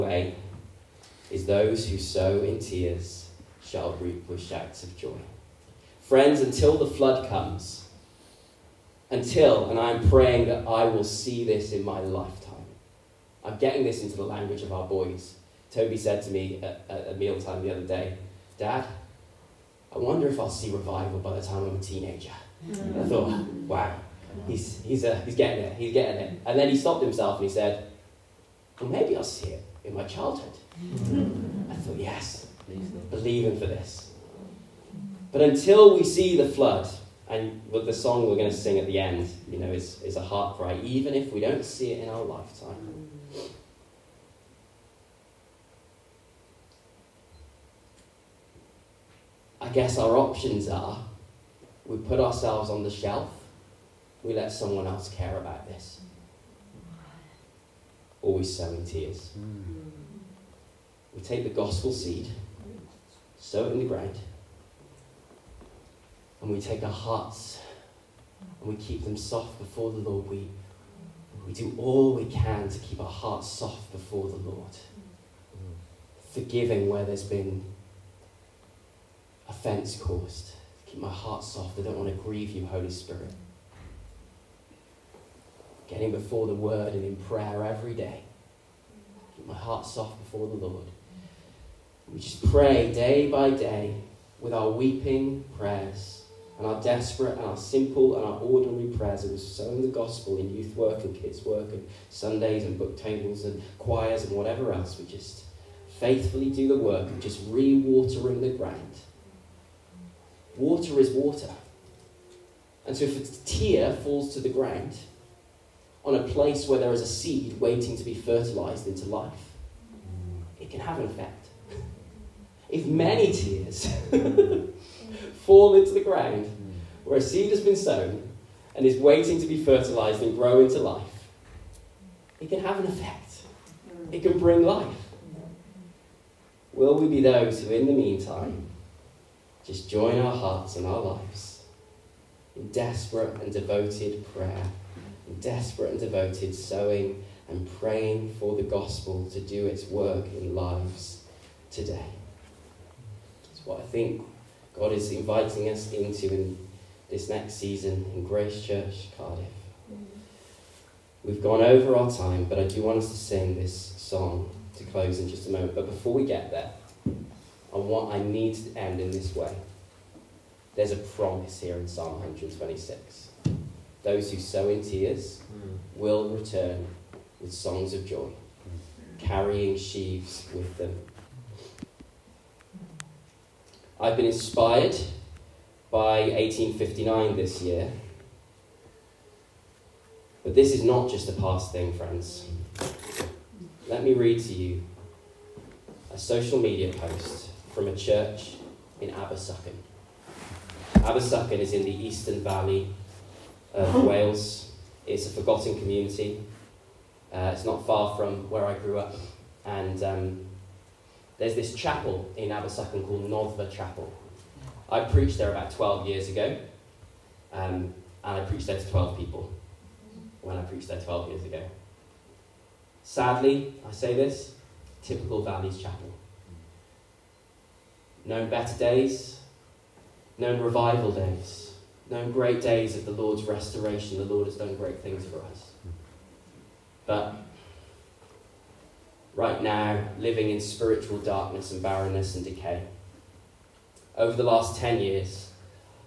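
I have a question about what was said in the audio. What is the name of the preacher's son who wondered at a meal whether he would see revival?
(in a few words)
Toby.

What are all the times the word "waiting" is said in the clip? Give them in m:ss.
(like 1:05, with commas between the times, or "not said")
1:57, 2:08.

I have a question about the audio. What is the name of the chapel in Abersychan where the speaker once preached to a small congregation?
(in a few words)
Noddfa Chapel.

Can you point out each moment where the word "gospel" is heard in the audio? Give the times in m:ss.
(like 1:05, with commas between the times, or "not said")
1:01, 1:39, 2:28.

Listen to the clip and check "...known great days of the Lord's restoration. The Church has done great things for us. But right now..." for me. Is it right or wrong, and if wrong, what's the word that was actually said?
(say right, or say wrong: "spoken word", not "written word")
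wrong: "Lord", not "Church".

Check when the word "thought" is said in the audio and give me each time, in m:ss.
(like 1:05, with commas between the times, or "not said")
0:23, 0:31.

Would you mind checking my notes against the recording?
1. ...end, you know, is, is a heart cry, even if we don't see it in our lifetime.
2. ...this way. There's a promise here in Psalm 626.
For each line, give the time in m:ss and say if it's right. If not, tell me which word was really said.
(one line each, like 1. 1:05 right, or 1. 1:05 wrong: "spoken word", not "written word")
1. 0:38 right
2. 2:49 wrong: "126", not "626".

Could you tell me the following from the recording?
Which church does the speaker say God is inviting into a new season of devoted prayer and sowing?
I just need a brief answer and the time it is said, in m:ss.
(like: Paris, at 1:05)
Grace Church, Cardiff, at 2:38.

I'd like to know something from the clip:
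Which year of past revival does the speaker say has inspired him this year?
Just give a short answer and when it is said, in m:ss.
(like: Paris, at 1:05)
1859, at 3:06.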